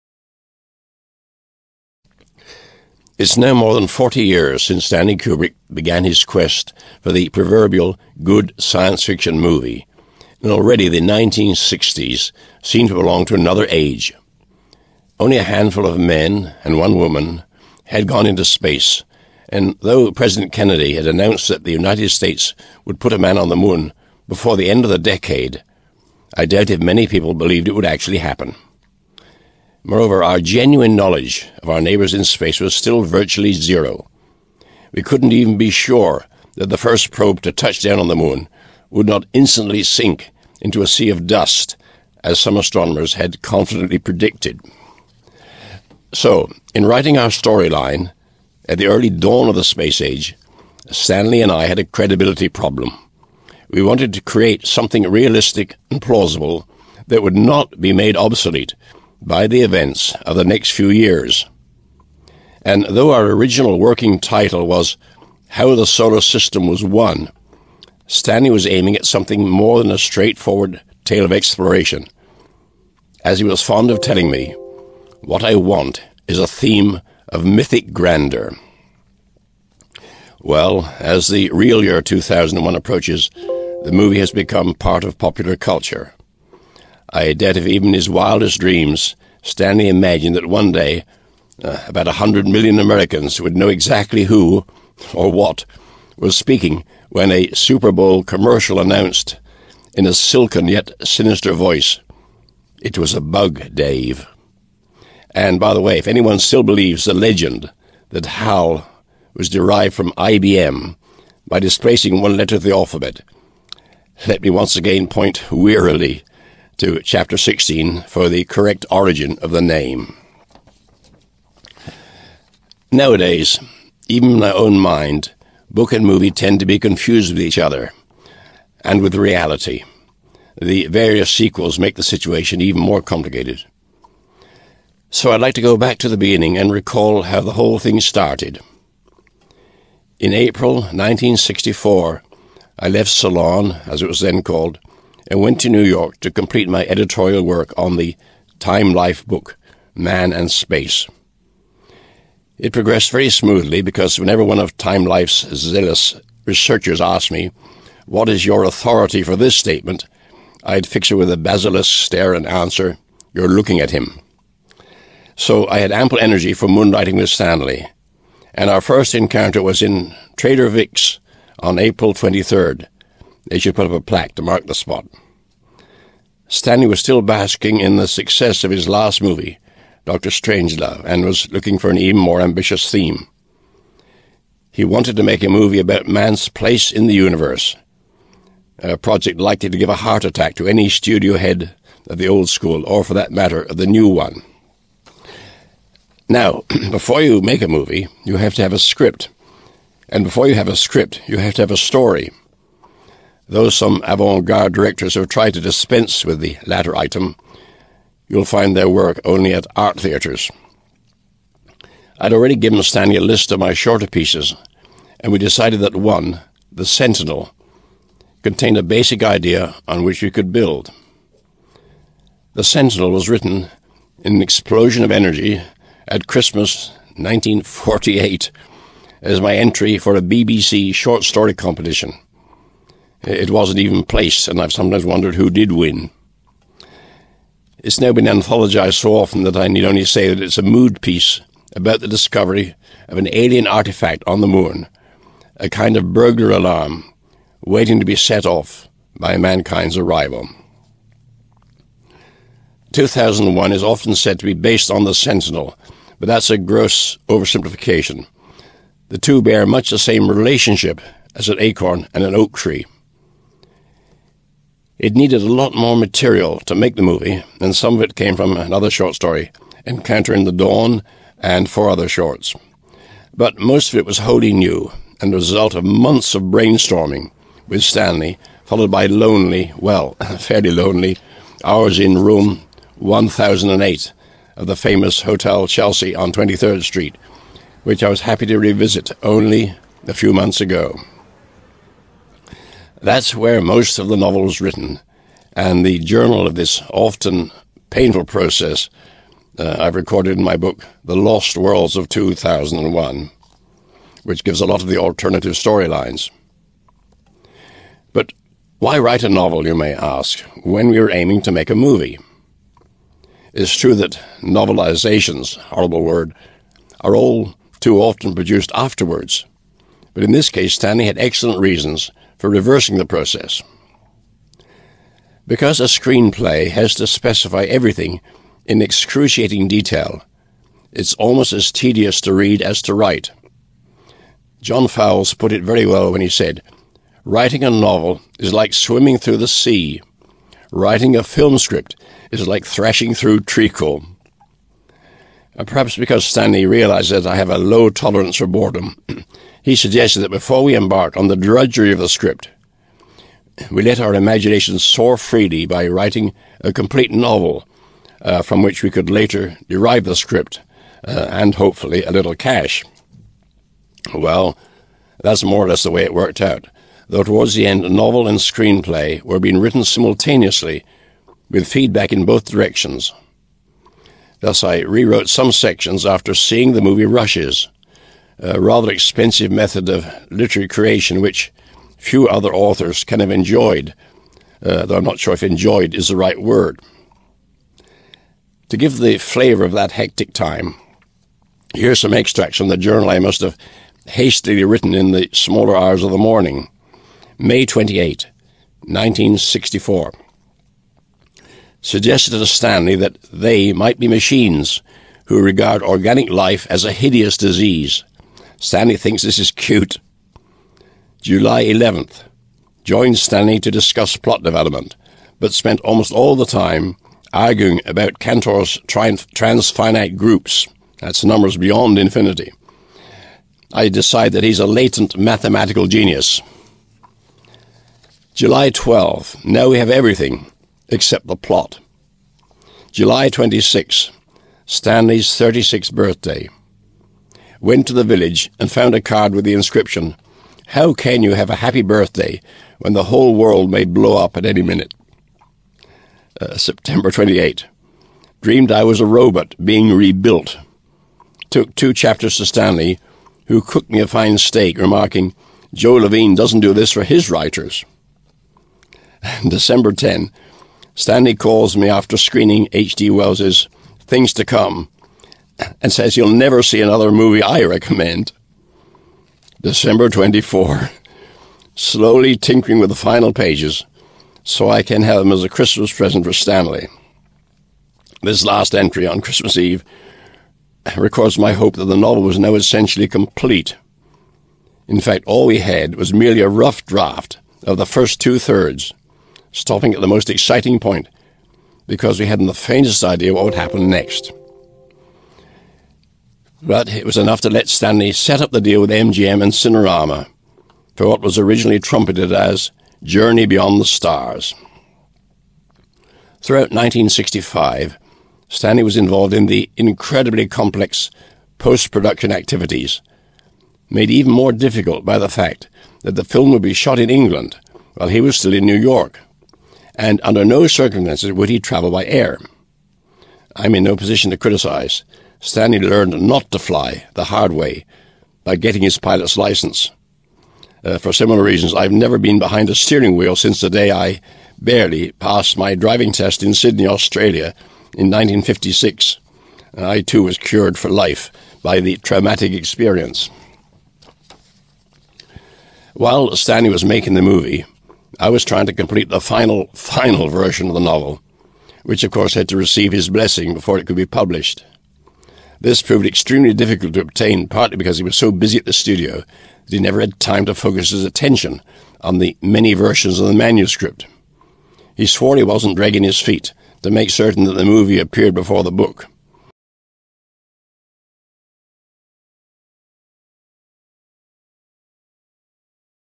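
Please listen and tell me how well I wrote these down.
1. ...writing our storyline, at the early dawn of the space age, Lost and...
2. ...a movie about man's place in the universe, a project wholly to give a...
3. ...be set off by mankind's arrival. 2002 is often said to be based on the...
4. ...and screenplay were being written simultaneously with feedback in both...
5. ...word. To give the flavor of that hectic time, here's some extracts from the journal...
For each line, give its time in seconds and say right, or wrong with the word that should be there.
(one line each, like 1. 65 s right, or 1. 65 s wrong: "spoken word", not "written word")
1. 46 s wrong: "Stanley", not "Lost"
2. 185 s wrong: "likely", not "wholly"
3. 248 s wrong: "2001", not "2002"
4. 368 s right
5. 386 s right.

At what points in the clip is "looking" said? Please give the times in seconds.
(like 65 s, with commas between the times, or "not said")
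163 s, 181 s.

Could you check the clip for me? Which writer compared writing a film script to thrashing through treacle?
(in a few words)
John Fowles.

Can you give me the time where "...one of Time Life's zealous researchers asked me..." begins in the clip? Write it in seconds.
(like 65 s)
154 s.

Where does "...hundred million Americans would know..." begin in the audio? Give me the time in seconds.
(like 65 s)
92 s.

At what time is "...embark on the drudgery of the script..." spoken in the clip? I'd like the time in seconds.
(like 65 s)
350 s.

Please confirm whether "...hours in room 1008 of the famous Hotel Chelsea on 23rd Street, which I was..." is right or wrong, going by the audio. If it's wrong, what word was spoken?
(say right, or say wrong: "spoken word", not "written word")
right.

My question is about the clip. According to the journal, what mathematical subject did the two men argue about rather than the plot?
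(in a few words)
Cantor's transfinite groups.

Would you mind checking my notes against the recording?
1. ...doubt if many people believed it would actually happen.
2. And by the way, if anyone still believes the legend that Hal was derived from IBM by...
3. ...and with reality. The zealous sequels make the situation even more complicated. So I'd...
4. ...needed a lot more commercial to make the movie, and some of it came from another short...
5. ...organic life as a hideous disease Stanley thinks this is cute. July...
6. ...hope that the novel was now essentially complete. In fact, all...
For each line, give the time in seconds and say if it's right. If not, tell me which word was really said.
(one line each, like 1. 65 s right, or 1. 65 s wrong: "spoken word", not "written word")
1. 26 s right
2. 105 s right
3. 128 s wrong: "various", not "zealous"
4. 265 s wrong: "material", not "commercial"
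5. 405 s right
6. 481 s right.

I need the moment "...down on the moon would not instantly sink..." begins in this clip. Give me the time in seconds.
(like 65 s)
37 s.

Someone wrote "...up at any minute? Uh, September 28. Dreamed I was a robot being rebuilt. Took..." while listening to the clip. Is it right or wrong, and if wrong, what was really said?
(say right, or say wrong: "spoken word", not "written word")
right.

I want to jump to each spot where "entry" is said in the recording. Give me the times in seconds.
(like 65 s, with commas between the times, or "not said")
229 s, 478 s.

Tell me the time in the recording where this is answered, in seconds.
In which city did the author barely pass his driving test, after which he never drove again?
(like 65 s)
536 s.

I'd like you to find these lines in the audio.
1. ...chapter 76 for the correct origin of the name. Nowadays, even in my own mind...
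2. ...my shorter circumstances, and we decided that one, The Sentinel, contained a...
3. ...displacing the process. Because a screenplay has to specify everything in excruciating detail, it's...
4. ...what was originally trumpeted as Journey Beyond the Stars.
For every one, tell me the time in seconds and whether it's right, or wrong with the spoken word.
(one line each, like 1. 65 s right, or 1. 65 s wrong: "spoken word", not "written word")
1. 117 s wrong: "16", not "76"
2. 213 s wrong: "pieces", not "circumstances"
3. 322 s wrong: "reversing", not "displacing"
4. 501 s right.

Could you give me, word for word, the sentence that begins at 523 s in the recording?
I'm in no position to criticize Stanley learned not to fly the hard way by getting his pilot's license.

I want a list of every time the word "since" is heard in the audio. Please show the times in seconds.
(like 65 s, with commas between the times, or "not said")
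4 s, 533 s.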